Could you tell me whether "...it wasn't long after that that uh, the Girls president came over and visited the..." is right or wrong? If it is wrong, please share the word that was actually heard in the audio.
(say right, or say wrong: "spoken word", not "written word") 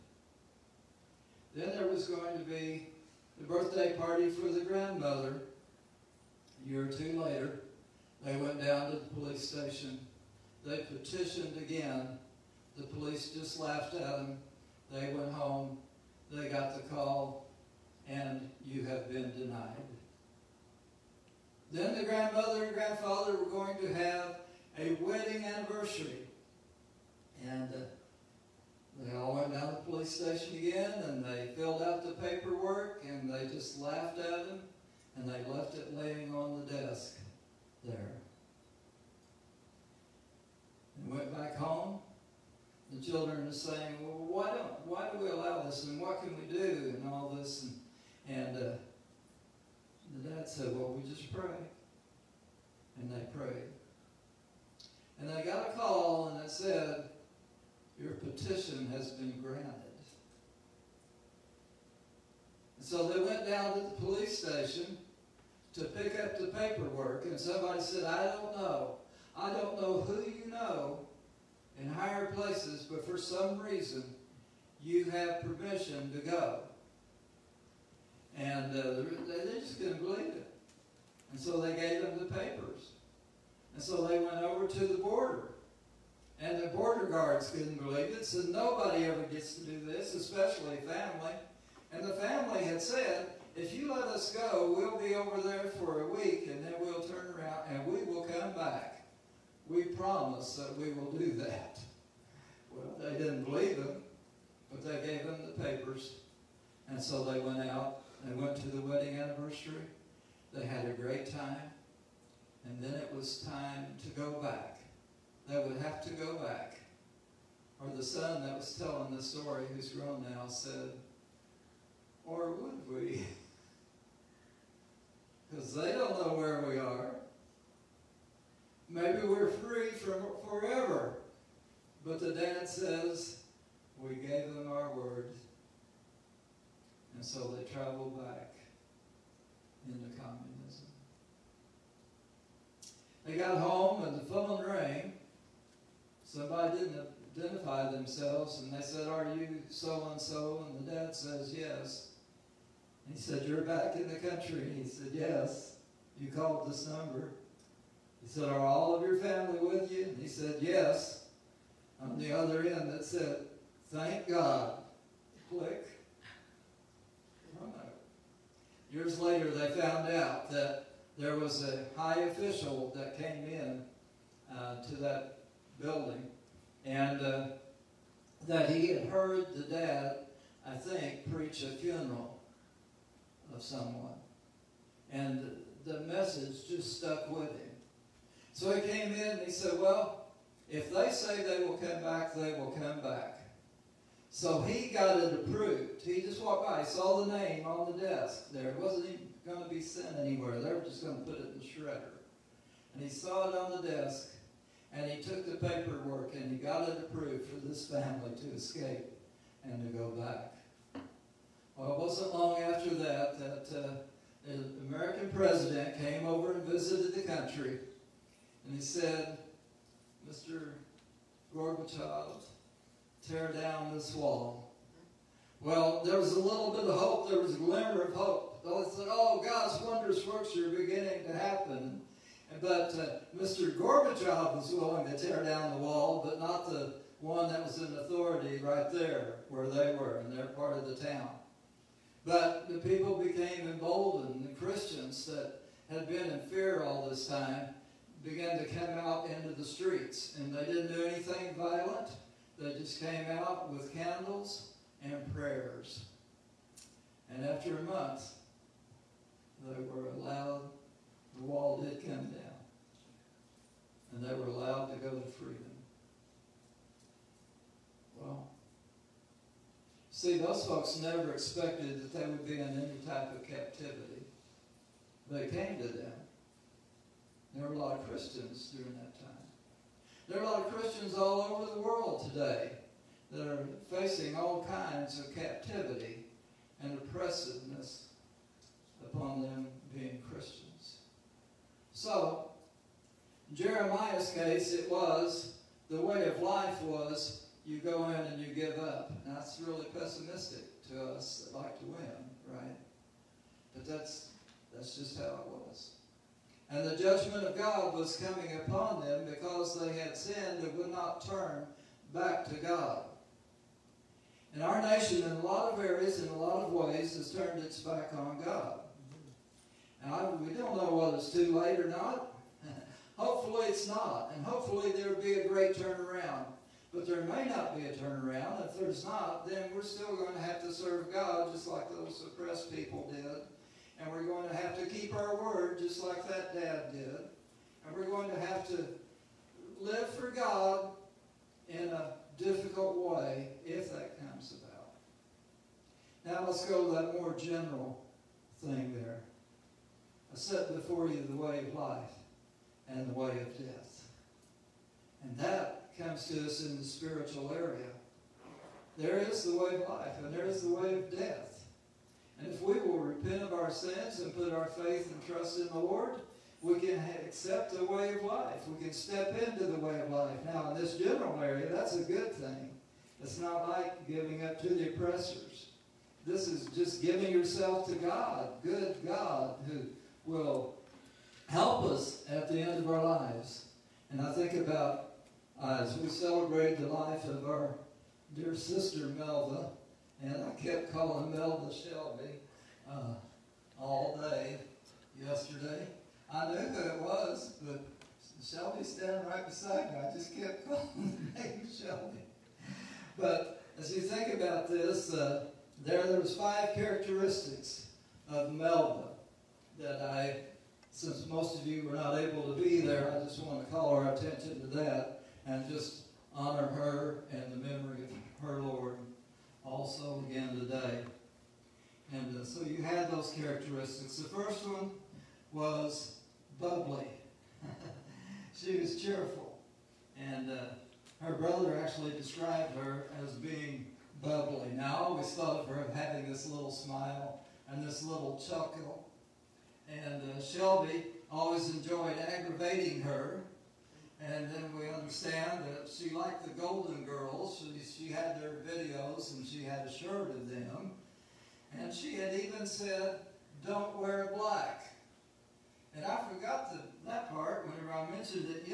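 wrong: "American", not "Girls".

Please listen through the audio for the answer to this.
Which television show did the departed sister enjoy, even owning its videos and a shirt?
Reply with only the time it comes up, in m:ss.
7:26.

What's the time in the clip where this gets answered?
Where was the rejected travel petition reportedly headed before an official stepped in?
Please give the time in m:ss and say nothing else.
3:21.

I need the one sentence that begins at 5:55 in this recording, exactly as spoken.
And that comes to us in the spiritual area.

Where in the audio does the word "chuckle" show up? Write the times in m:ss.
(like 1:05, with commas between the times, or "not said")
7:18.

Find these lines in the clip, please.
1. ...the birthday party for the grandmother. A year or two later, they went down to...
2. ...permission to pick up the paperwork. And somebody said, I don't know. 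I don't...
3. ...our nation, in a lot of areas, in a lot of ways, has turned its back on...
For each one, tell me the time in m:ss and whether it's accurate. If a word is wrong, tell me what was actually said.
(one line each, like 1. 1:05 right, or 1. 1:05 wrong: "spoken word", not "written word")
1. 0:03 right
2. 1:04 wrong: "station", not "permission"
3. 5:14 right.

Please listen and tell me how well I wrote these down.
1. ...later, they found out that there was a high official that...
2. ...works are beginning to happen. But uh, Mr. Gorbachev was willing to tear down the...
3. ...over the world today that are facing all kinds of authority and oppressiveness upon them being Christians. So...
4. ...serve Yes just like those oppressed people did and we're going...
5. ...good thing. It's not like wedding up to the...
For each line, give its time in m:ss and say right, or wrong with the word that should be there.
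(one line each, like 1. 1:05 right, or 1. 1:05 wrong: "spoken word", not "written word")
1. 2:49 right
2. 3:50 right
3. 4:41 wrong: "captivity", not "authority"
4. 5:30 wrong: "God", not "Yes"
5. 6:12 wrong: "giving", not "wedding".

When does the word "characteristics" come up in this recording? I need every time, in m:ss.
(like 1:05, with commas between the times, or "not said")
6:46, 7:03.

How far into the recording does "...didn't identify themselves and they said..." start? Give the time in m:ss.
2:26.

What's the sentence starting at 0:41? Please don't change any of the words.
And went back home, the children are saying, well, why, don't, why do we allow this?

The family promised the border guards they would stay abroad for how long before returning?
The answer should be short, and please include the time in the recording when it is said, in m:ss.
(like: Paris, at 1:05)
a week, at 1:36.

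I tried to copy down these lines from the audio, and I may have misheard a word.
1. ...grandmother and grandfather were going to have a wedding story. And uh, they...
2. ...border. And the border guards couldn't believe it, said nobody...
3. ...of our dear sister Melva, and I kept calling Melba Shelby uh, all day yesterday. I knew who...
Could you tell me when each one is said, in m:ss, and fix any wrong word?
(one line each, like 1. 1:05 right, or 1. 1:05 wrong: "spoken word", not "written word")
1. 0:22 wrong: "anniversary", not "story"
2. 1:24 right
3. 6:27 right.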